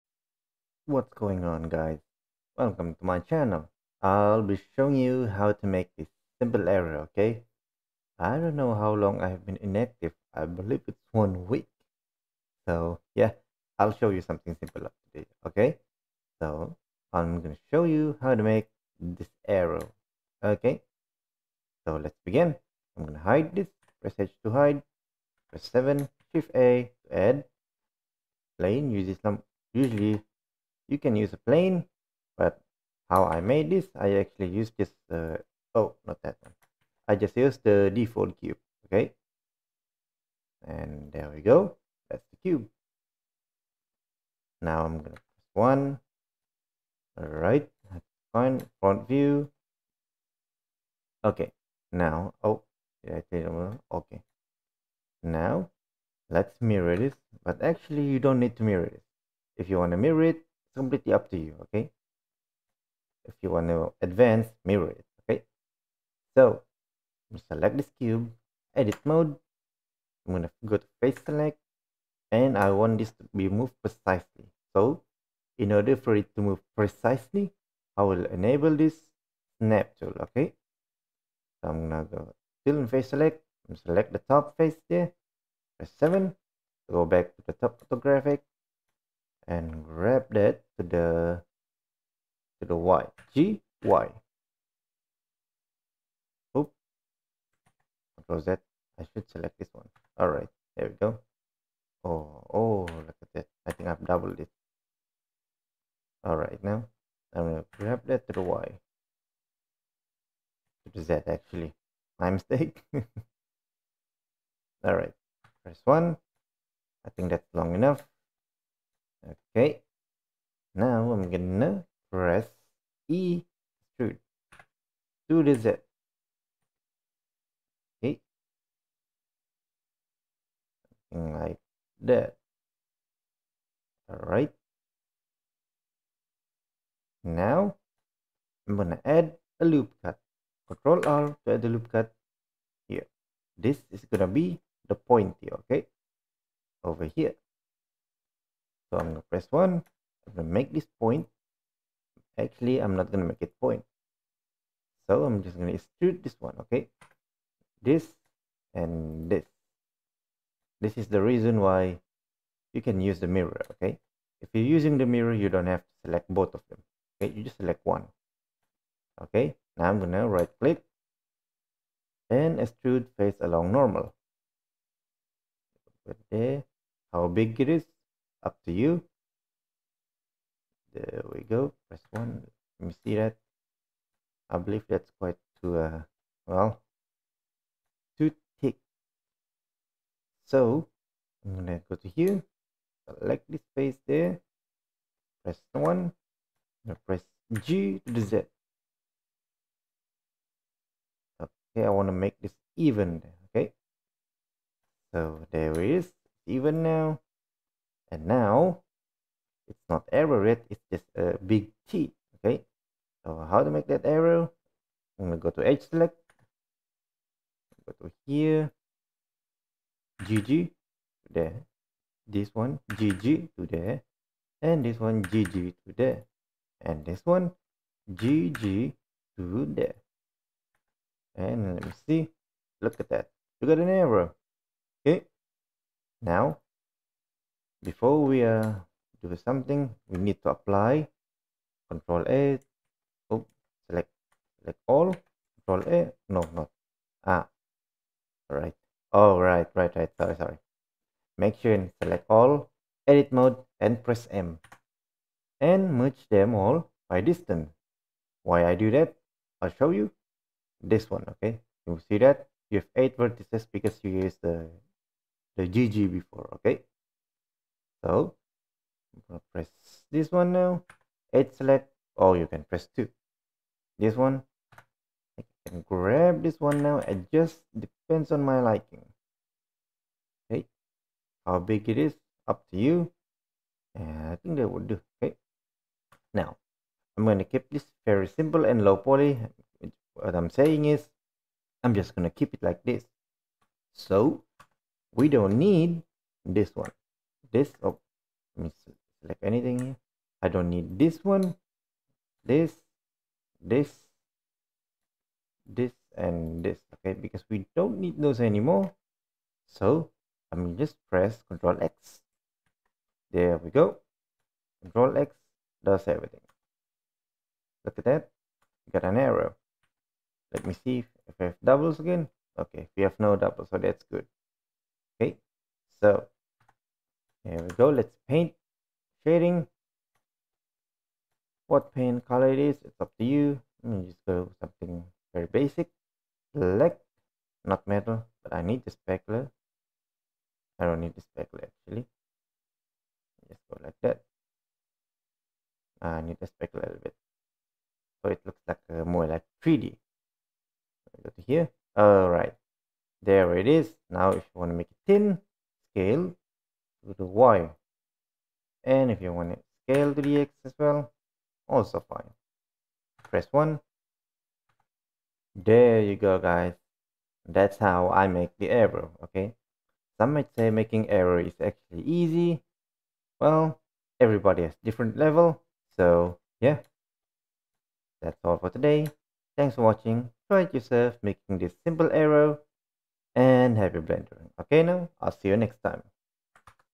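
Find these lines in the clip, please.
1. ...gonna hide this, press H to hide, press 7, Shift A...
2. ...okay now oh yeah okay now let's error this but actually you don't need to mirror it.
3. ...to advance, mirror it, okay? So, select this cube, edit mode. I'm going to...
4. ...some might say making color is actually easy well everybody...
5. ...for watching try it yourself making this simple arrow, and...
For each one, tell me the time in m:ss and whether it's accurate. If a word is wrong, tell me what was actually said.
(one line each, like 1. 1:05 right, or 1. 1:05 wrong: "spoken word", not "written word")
1. 0:23 right
2. 0:51 wrong: "mirror", not "error"
3. 1:03 right
4. 6:10 wrong: "error", not "color"
5. 6:19 right.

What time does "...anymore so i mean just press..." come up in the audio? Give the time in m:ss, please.
5:08.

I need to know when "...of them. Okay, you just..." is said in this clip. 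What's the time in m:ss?
2:46.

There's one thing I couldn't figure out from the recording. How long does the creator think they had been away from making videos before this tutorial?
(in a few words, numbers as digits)
one week.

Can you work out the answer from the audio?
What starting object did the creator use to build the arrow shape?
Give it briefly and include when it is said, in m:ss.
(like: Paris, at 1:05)
the default cube, at 0:37.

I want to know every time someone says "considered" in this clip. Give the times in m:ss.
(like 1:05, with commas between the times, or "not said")
not said.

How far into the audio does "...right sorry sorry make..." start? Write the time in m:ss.
4:09.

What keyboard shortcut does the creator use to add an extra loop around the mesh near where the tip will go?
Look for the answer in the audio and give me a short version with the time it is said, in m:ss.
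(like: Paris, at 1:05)
Control R, at 2:20.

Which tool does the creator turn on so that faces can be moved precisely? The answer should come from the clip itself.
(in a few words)
snap tool.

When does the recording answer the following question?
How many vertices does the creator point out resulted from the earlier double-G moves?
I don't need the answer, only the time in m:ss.
4:23.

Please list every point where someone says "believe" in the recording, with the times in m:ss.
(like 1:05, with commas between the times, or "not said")
0:10, 3:04.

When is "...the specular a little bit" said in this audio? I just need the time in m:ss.
5:46.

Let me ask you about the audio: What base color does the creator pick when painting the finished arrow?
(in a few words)
Black.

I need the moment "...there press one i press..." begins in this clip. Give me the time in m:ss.
3:14.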